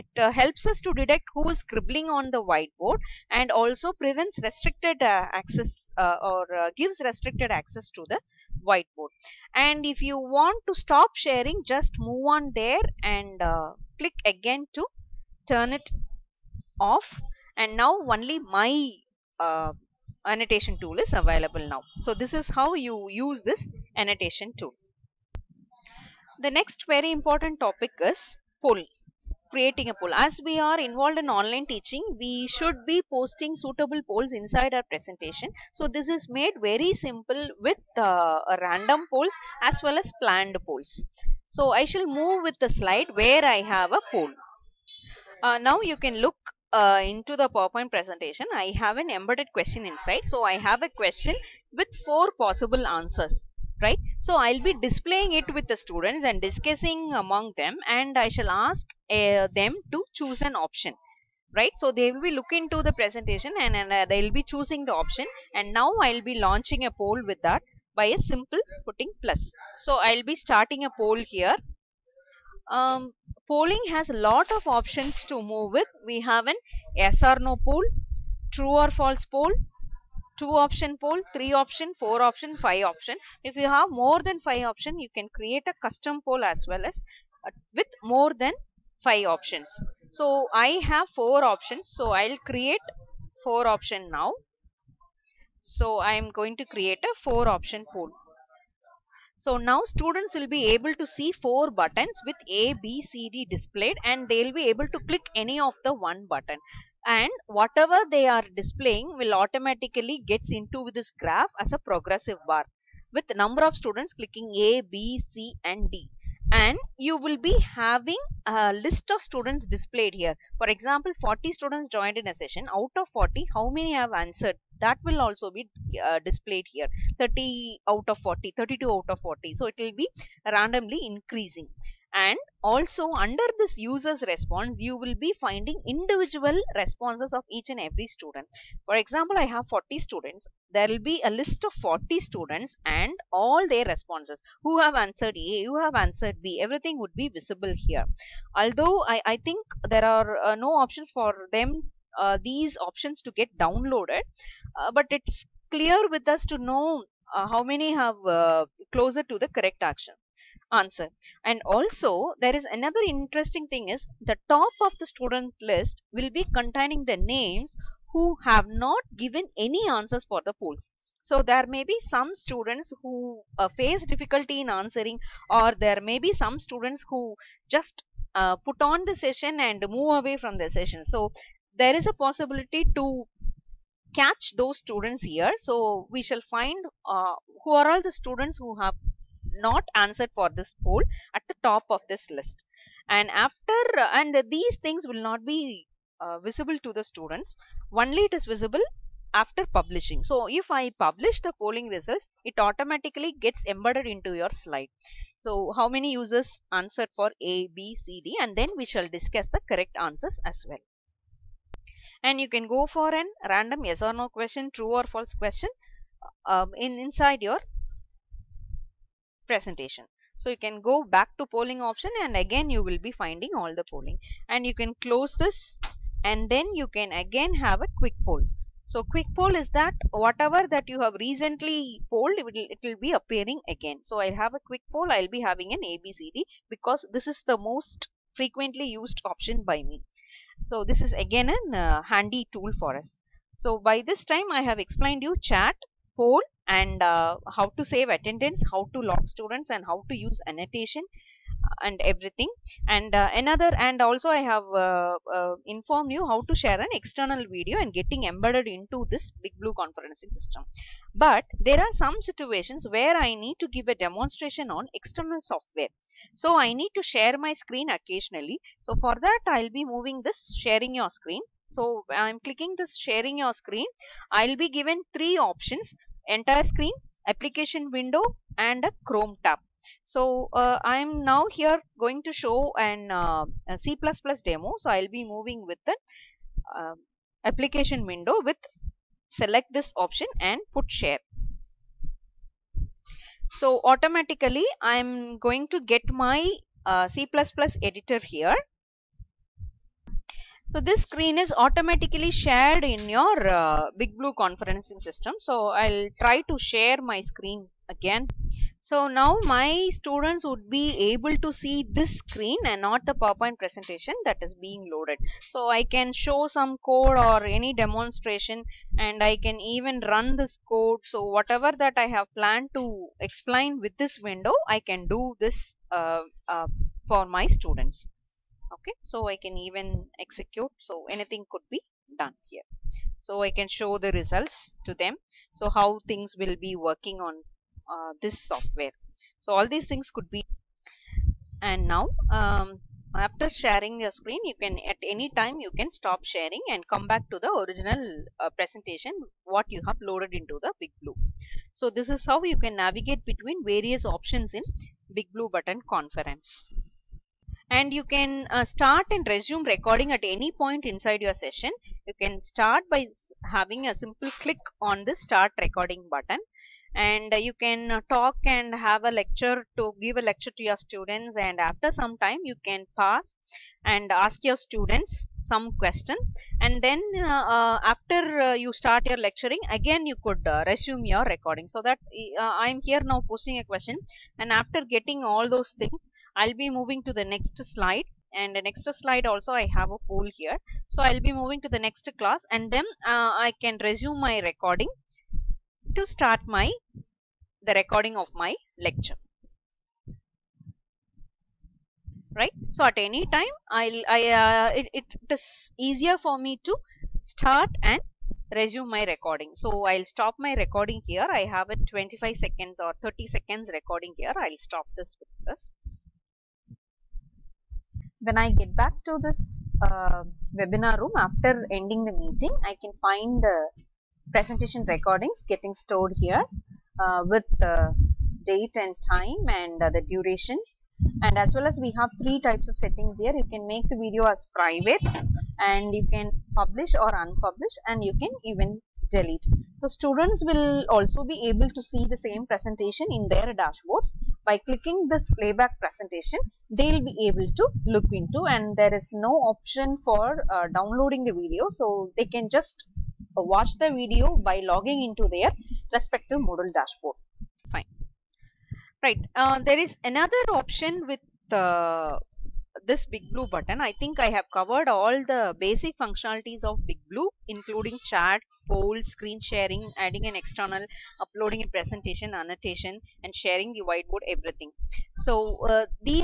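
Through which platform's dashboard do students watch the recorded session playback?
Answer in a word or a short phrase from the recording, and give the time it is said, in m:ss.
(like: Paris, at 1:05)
Moodle, at 7:36.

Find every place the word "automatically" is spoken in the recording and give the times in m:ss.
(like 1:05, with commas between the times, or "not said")
1:49, 3:22, 4:53, 5:01.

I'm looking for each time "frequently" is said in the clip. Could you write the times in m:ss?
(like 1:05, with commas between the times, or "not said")
3:58.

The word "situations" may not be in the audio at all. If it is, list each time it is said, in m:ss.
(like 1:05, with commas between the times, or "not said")
4:22.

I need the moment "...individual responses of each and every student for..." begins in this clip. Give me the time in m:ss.
2:15.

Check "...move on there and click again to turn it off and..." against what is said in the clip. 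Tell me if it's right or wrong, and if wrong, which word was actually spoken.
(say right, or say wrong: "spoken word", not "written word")
right.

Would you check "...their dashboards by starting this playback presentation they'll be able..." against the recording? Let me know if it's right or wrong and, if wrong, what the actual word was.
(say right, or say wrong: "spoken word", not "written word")
wrong: "clicking", not "starting".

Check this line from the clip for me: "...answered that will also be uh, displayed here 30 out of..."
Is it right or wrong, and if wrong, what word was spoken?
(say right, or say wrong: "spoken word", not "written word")
right.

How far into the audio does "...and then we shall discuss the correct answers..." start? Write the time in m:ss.
3:28.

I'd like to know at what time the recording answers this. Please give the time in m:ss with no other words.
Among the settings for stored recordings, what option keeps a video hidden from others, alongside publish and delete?
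7:14.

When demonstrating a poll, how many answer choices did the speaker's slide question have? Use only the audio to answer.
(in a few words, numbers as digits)
4.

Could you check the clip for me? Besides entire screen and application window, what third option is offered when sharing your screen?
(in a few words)
Chrome tab.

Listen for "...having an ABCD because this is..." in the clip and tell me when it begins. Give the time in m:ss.
3:55.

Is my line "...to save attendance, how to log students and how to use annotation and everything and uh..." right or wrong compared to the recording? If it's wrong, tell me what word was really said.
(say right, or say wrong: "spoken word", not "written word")
right.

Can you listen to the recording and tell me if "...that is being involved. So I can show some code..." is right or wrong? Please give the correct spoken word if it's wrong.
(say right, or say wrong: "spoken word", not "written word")
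wrong: "loaded", not "involved".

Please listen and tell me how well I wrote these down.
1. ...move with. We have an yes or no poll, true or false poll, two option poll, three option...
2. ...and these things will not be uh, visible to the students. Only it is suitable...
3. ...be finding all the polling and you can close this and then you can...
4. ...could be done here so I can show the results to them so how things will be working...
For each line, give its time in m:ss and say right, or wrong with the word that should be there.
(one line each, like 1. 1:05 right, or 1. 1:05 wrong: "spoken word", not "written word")
1. 1:15 right
2. 3:14 wrong: "visible", not "suitable"
3. 3:42 right
4. 5:31 right.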